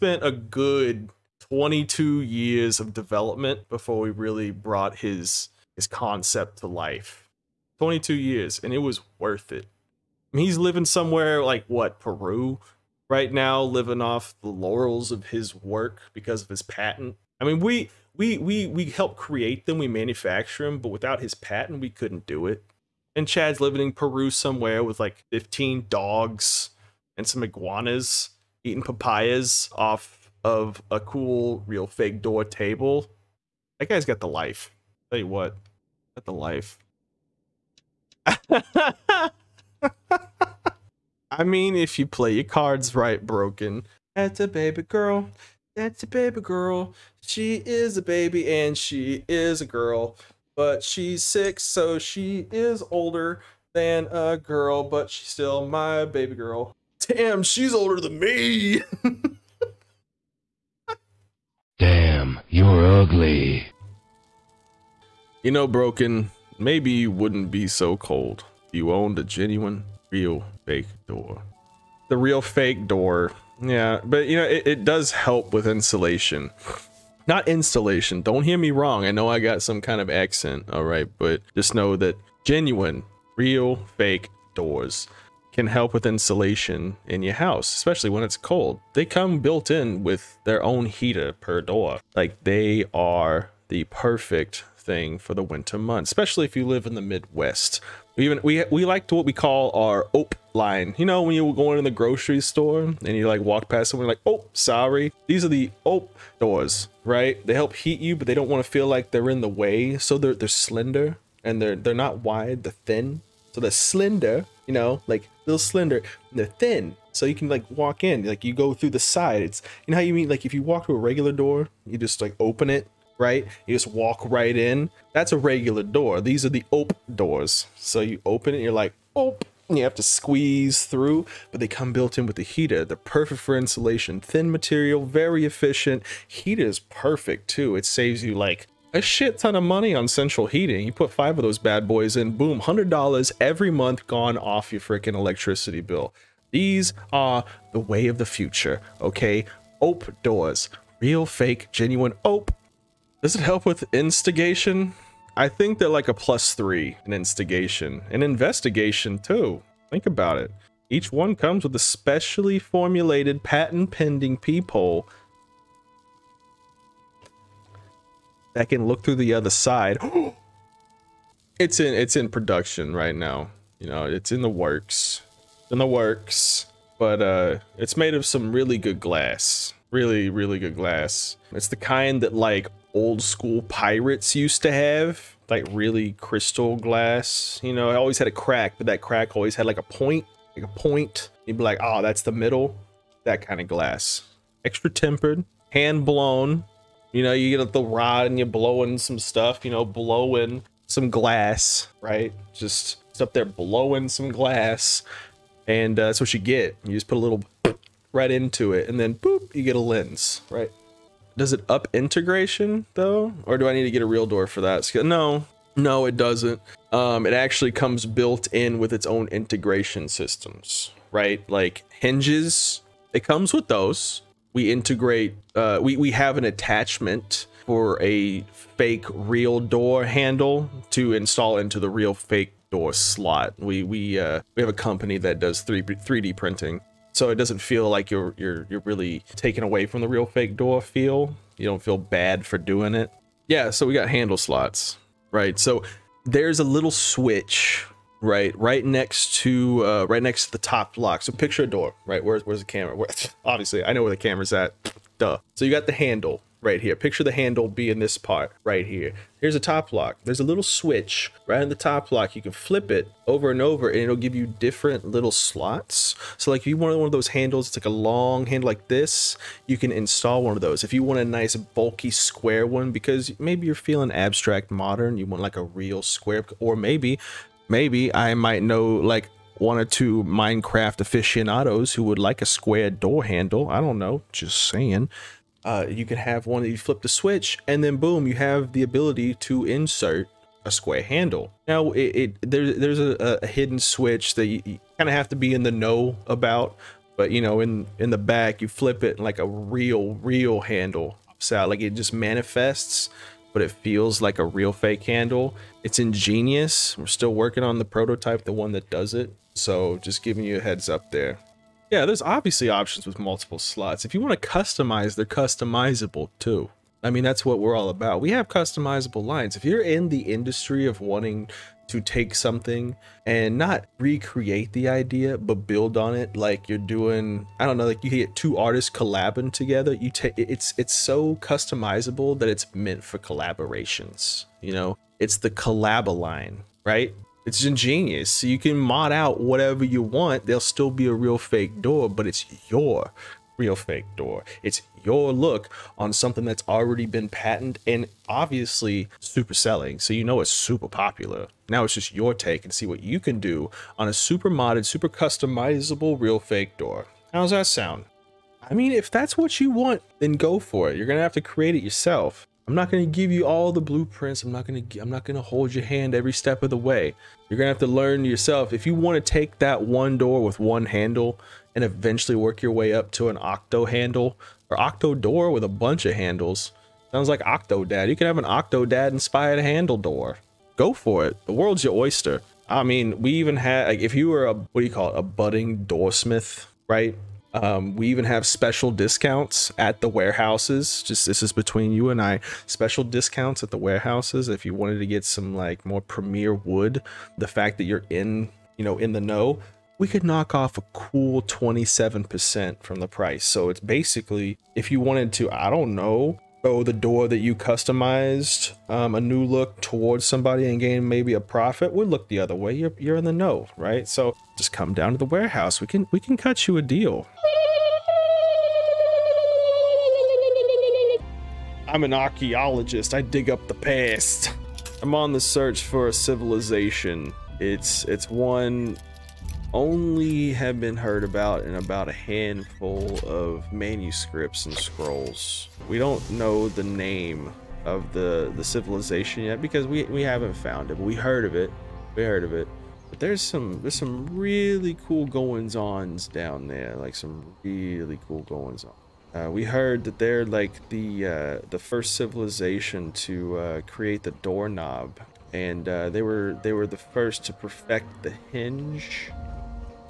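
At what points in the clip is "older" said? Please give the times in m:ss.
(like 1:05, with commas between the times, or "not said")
0:52, 0:57.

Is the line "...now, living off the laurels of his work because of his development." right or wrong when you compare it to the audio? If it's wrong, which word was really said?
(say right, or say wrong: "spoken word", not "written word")
wrong: "patent", not "development".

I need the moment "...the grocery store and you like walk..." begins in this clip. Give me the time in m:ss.
1:41.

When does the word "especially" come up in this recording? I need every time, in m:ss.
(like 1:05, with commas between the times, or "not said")
1:27, 1:36.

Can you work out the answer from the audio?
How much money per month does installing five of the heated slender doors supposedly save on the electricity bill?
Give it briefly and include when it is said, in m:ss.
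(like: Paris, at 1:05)
$100, at 2:22.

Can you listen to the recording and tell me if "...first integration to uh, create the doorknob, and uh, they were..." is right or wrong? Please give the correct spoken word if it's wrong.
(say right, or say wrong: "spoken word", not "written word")
wrong: "civilization", not "integration".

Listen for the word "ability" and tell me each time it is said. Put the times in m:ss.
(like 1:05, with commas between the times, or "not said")
4:48.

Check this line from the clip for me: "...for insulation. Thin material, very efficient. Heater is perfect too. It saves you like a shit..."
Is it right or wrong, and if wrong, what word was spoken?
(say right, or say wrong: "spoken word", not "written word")
right.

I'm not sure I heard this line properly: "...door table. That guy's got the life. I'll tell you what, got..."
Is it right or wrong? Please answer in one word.
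right.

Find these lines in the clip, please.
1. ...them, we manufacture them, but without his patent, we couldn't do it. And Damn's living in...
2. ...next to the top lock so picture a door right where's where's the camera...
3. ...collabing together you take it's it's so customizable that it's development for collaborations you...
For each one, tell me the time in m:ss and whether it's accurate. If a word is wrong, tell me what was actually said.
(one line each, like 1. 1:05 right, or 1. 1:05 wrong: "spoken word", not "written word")
1. 0:19 wrong: "Chad", not "Damn"
2. 4:10 right
3. 5:28 wrong: "meant", not "development".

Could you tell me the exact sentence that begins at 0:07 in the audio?
22 years, and it was worth it.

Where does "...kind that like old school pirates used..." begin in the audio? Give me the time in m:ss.
3:01.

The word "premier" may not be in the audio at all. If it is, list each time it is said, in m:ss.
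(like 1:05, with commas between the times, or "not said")
6:36.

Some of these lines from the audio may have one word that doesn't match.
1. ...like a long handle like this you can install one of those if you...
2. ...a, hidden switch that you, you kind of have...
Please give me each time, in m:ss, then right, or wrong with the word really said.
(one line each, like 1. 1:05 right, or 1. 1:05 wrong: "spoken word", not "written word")
1. 4:27 right
2. 4:53 right.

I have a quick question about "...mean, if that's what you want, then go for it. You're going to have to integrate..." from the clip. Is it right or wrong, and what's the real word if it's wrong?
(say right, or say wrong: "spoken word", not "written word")
wrong: "create", not "integrate".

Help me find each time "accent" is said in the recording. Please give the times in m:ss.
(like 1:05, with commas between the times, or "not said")
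1:20.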